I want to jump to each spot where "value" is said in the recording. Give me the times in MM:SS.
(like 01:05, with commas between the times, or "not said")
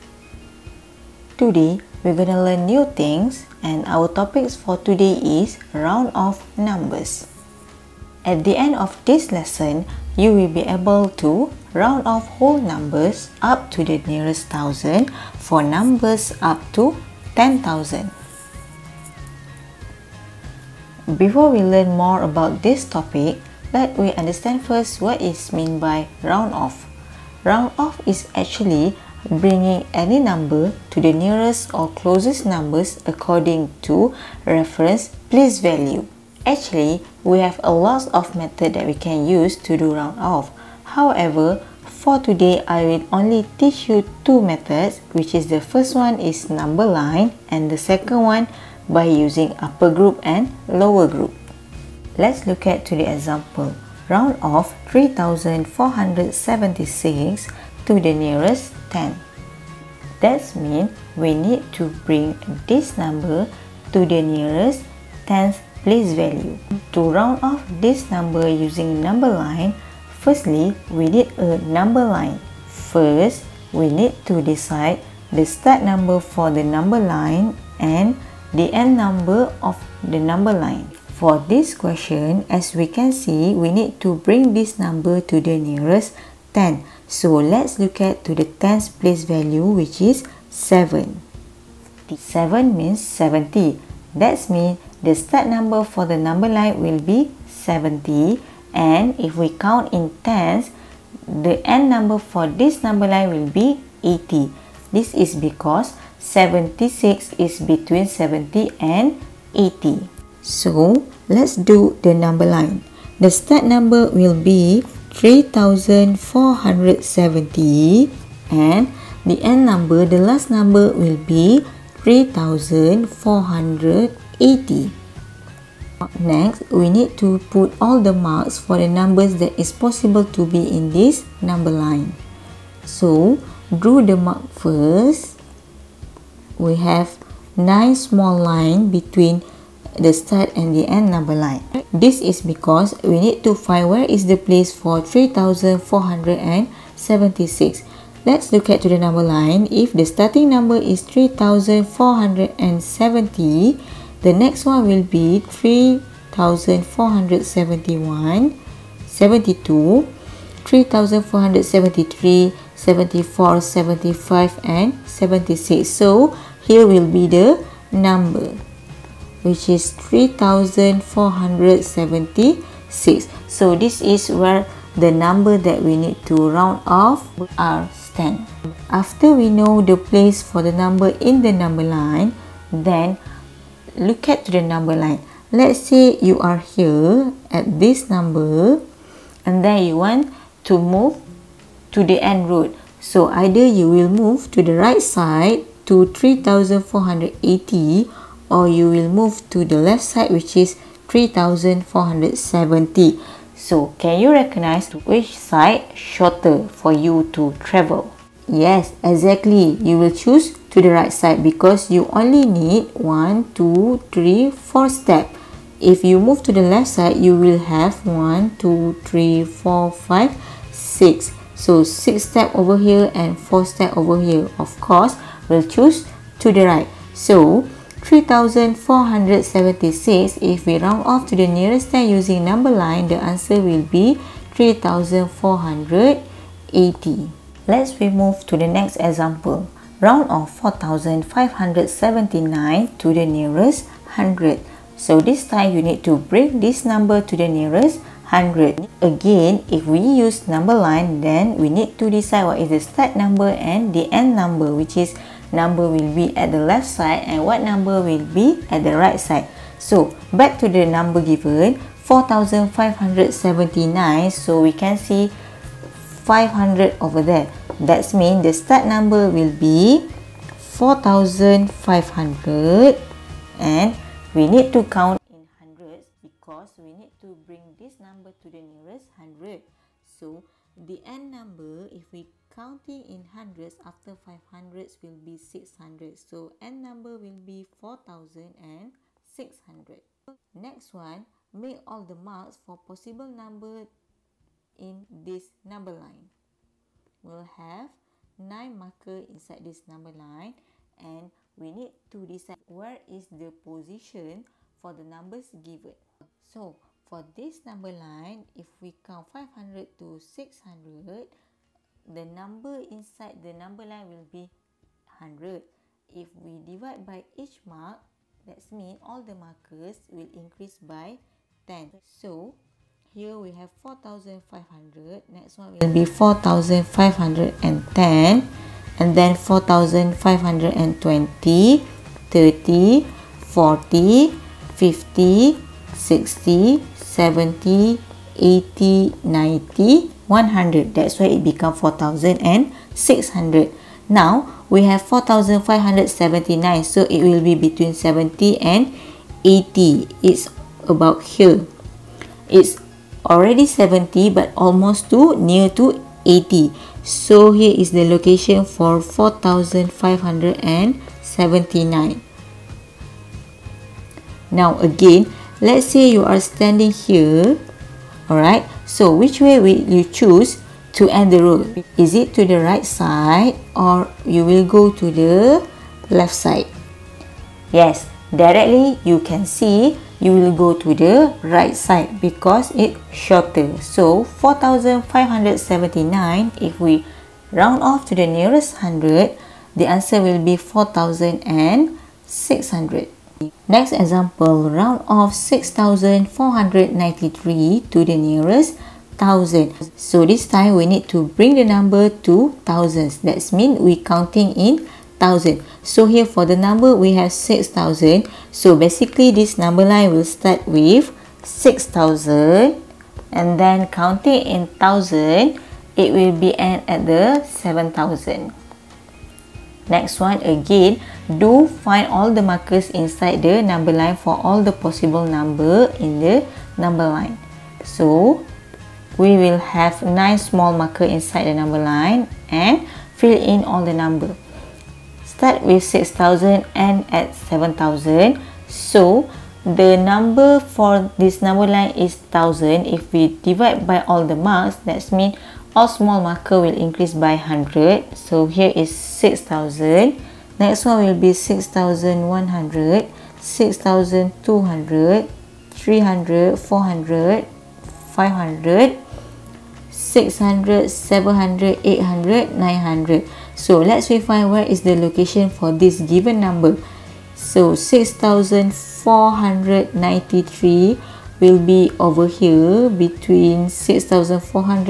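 00:35, 01:06, 01:29.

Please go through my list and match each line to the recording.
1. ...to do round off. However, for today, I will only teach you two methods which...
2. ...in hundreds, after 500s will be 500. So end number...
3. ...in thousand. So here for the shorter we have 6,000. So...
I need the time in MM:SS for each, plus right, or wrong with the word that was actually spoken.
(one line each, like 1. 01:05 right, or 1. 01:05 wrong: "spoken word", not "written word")
1. 00:39 right
2. 04:43 wrong: "600", not "500"
3. 06:44 wrong: "number", not "shorter".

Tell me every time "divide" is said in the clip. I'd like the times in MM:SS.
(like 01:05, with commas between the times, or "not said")
05:16, 07:23.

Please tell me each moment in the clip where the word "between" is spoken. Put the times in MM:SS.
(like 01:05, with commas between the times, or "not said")
01:47, 02:18.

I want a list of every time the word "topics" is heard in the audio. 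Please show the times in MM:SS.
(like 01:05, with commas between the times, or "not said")
00:04, 00:22.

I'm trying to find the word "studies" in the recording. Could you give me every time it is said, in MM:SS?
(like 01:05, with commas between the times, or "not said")
not said.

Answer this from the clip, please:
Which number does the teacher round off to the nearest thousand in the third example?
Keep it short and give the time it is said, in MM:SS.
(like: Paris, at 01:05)
6493, at 06:35.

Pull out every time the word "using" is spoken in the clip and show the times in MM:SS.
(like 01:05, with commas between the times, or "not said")
00:49, 01:08, 03:52.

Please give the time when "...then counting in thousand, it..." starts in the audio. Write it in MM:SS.
06:53.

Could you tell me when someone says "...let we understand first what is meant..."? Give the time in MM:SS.
00:23.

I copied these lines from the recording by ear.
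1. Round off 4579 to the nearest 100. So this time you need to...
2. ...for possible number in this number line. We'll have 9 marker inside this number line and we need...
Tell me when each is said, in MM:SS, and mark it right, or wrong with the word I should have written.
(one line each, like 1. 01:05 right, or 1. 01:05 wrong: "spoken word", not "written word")
1. 04:00 right
2. 04:52 right.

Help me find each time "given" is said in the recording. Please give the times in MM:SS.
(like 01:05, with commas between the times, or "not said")
04:21, 05:05.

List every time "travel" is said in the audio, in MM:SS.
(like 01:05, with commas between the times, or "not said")
03:27.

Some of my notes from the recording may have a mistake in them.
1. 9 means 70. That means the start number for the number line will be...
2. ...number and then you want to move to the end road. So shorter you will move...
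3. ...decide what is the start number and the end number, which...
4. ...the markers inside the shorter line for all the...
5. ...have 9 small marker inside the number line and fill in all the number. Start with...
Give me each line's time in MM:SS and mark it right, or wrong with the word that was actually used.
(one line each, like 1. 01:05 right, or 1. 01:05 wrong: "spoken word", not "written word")
1. 01:32 wrong: "7", not "9"
2. 03:08 wrong: "either", not "shorter"
3. 04:12 right
4. 07:02 wrong: "number", not "shorter"
5. 07:09 right.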